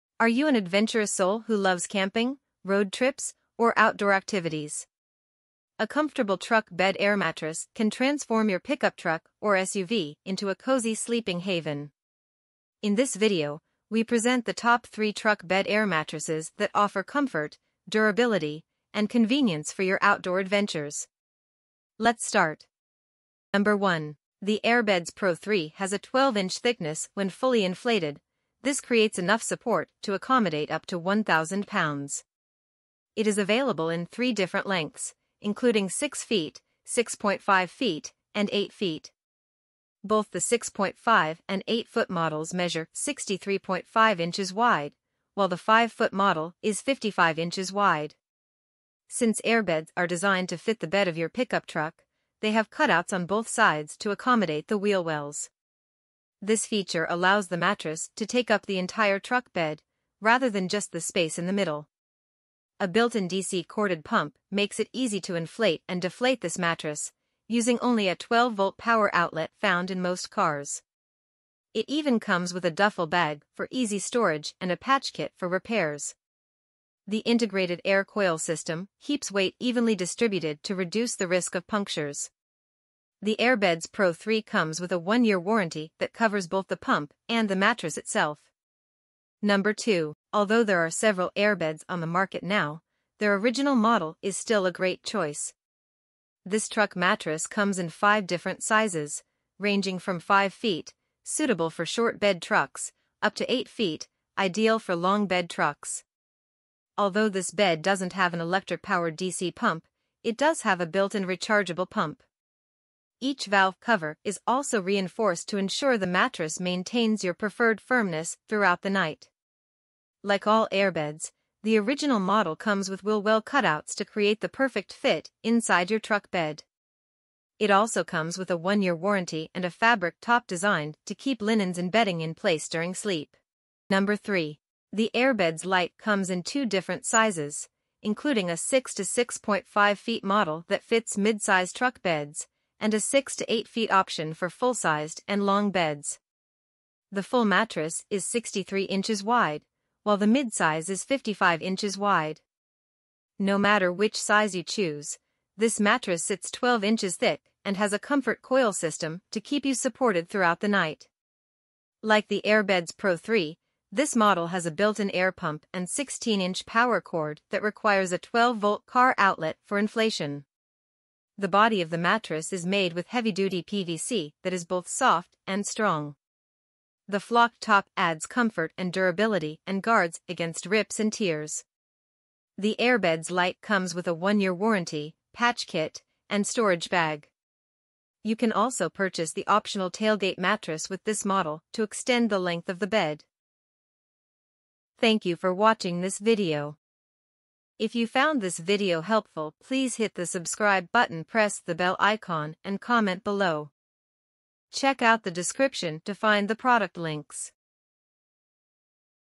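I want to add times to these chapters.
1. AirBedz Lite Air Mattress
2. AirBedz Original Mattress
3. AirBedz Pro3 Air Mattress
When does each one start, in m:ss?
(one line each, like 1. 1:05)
1. 2:23
2. 1:29
3. 0:23.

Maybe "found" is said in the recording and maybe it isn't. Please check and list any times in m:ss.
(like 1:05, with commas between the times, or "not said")
1:09, 3:18.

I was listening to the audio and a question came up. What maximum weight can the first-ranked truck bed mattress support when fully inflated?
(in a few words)
1,000 pounds.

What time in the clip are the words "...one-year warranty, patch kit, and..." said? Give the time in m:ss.
3:04.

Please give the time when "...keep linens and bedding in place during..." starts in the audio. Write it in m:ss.
2:11.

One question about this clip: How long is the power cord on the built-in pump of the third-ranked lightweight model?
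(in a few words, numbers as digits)
16 inches.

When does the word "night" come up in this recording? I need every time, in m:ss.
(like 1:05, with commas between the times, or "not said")
1:58, 2:40.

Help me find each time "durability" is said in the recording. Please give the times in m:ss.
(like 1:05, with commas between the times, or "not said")
0:17, 2:58.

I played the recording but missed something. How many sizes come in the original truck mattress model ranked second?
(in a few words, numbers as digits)
5.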